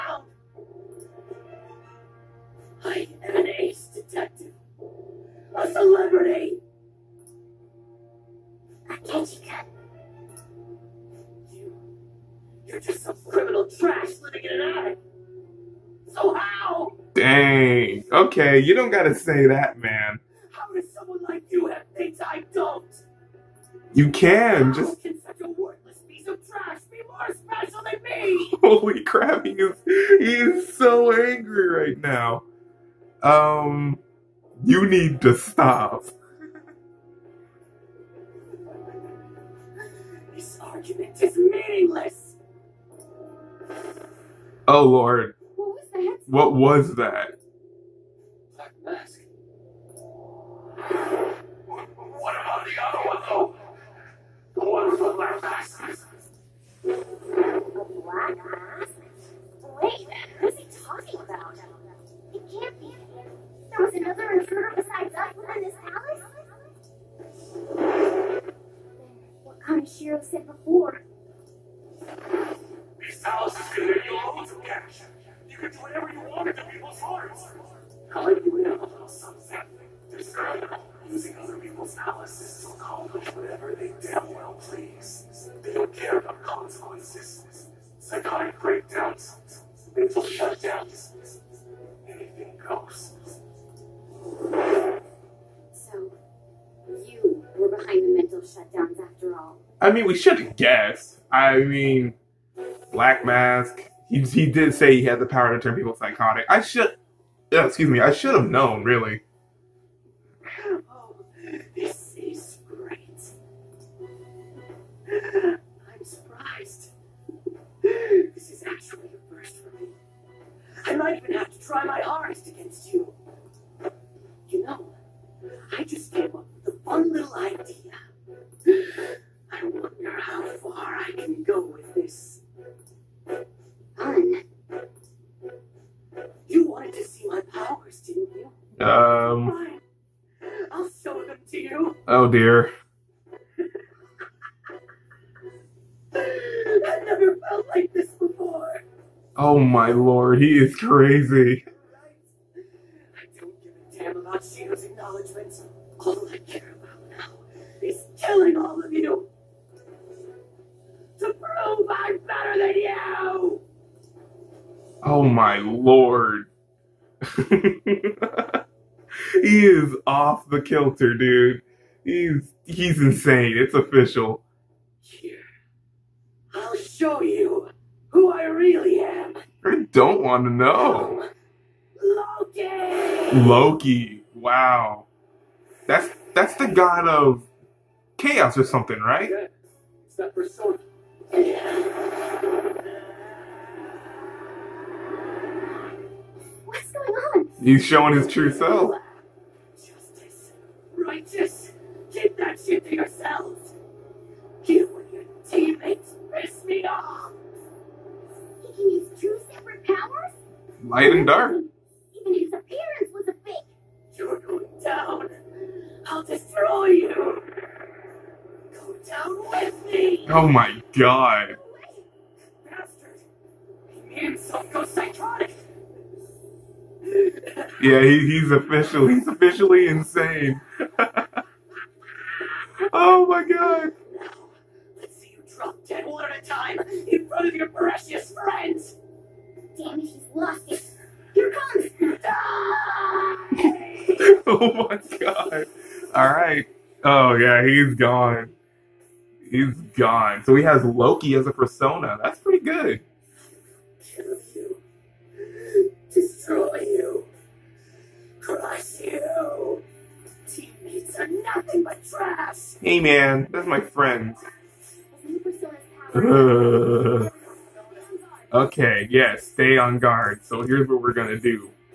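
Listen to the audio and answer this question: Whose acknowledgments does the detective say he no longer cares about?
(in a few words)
Shido.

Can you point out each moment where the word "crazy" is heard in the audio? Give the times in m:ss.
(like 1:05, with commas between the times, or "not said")
2:30.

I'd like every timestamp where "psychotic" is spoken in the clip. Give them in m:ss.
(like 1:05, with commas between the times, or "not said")
1:28, 1:45.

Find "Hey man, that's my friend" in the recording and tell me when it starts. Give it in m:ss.
4:22.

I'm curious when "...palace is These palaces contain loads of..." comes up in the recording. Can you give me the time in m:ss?
1:13.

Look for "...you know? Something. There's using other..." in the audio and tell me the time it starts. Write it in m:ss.
1:18.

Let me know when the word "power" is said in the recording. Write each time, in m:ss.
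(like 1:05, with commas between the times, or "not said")
1:45, 2:17.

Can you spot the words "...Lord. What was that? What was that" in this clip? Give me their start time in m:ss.
0:44.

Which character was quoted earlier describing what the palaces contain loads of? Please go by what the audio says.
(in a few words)
Kaneshiro.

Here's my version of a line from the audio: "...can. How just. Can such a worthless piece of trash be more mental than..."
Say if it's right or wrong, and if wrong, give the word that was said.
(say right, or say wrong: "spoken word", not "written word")
wrong: "special", not "mental".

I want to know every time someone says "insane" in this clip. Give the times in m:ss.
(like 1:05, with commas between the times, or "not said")
2:53, 3:49.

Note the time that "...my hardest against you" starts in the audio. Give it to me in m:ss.
2:01.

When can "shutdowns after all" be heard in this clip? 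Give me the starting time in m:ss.
1:38.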